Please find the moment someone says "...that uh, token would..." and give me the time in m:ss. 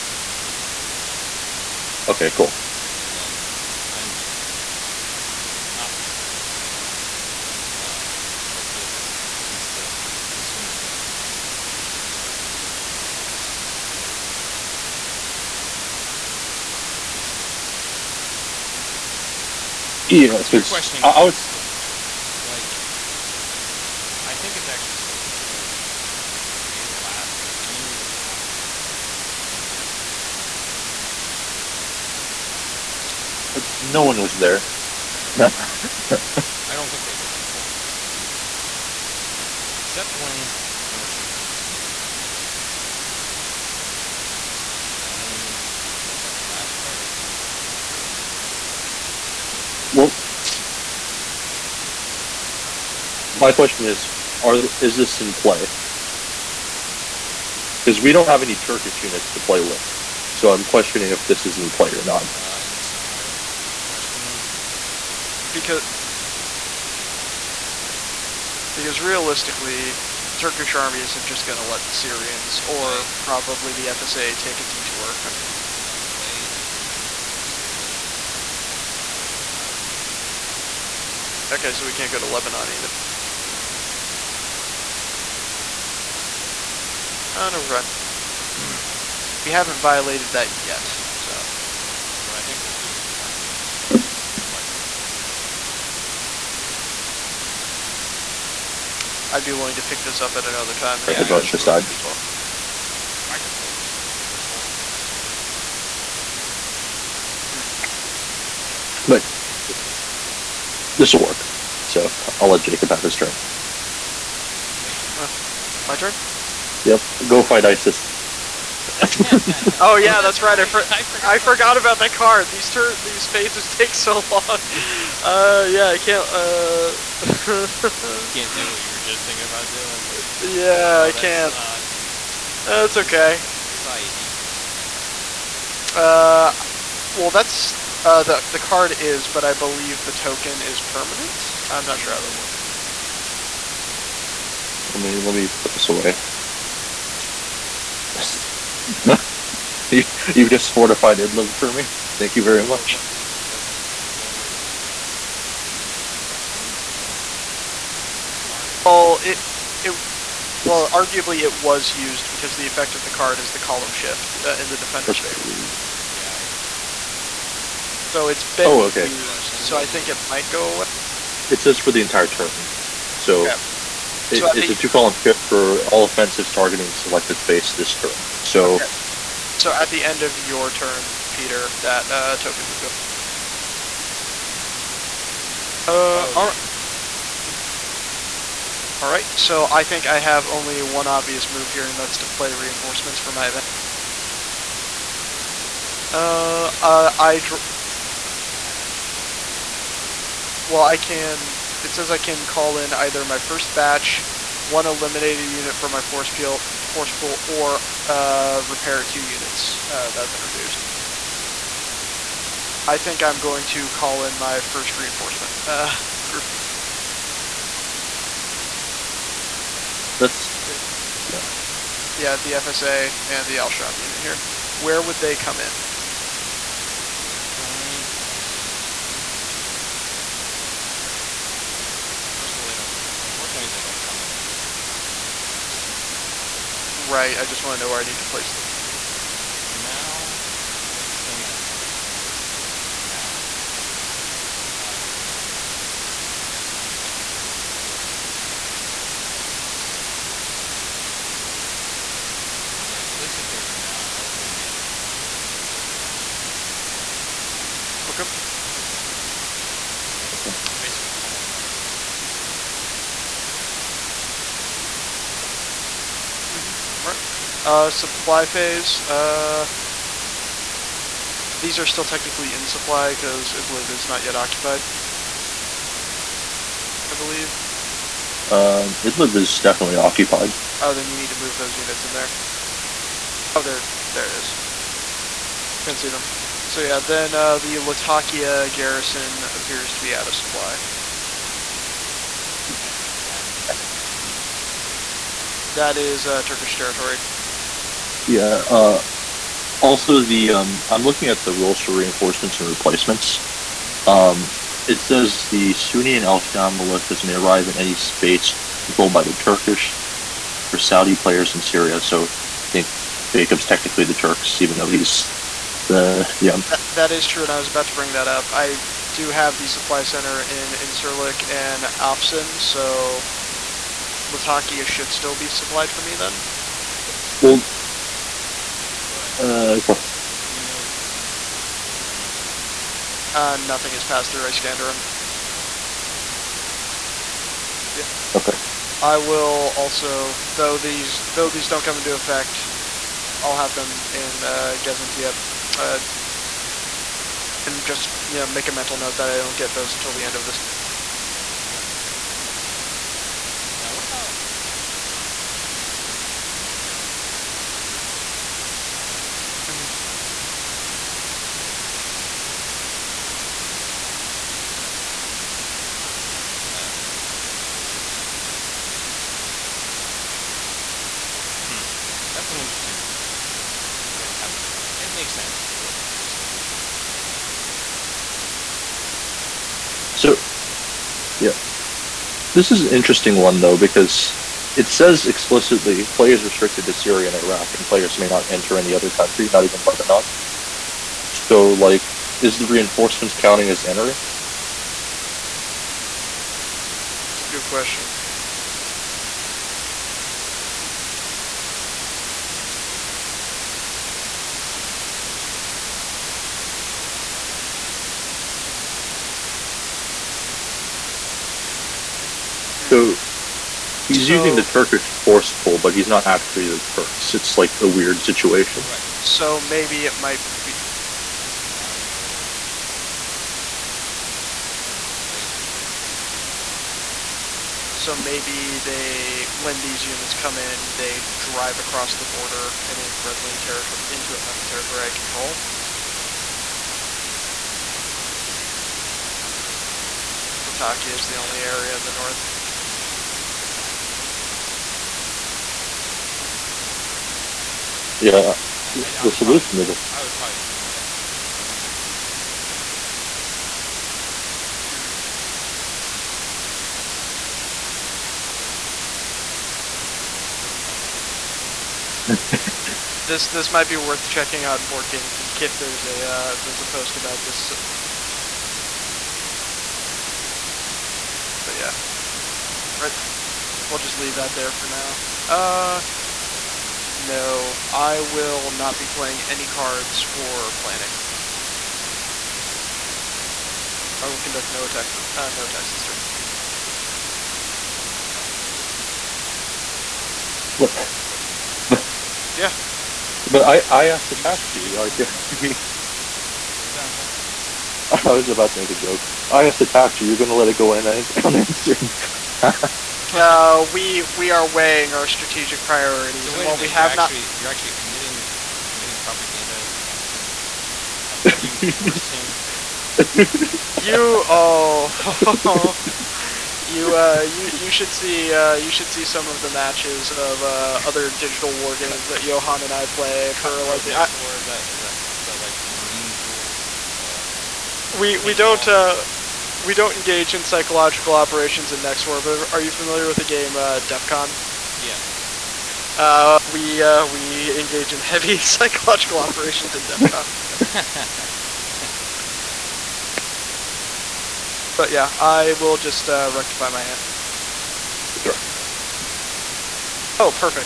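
3:01.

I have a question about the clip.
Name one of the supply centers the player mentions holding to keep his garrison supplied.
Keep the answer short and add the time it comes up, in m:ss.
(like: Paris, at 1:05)
Incirlik, at 5:20.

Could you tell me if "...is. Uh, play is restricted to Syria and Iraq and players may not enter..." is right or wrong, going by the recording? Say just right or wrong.
right.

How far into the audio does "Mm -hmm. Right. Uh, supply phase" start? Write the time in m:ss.
4:26.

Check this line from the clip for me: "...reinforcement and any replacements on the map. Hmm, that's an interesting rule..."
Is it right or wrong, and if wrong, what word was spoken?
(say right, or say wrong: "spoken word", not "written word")
right.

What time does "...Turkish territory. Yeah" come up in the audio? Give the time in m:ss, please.
4:56.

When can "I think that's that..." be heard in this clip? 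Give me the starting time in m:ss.
7:16.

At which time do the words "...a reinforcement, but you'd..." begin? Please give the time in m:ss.
7:31.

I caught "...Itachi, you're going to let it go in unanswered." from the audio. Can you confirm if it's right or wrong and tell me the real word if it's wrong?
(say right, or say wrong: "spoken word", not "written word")
right.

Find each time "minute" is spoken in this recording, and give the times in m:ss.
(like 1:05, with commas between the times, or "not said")
3:39, 8:26.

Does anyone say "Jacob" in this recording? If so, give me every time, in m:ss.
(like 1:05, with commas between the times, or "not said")
1:52, 5:13.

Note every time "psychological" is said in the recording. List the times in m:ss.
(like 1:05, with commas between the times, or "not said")
8:50, 8:58.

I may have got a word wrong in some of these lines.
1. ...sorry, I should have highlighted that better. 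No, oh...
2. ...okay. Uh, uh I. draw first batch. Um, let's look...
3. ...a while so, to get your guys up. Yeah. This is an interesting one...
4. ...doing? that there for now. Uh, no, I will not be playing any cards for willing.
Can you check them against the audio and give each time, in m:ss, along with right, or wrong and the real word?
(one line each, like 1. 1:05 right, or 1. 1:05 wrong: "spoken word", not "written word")
1. 1:25 right
2. 3:15 right
3. 6:20 right
4. 7:54 wrong: "planning", not "willing".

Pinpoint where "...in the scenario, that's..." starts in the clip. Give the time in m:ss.
1:02.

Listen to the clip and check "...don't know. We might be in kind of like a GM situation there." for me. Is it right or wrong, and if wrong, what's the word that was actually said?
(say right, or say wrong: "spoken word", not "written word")
right.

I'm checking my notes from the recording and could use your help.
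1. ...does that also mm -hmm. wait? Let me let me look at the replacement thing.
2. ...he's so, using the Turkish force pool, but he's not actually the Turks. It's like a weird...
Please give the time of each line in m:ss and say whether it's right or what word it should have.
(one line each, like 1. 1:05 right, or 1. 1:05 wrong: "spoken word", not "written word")
1. 5:58 wrong: "event", not "replacement"
2. 6:54 right.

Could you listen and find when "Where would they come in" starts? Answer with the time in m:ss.
3:44.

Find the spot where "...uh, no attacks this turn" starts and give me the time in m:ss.
8:05.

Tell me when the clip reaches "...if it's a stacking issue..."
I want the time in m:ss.
7:23.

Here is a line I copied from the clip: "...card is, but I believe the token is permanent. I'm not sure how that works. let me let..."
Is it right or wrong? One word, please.
right.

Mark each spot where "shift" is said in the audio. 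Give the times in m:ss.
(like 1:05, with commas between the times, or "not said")
2:43, 2:55.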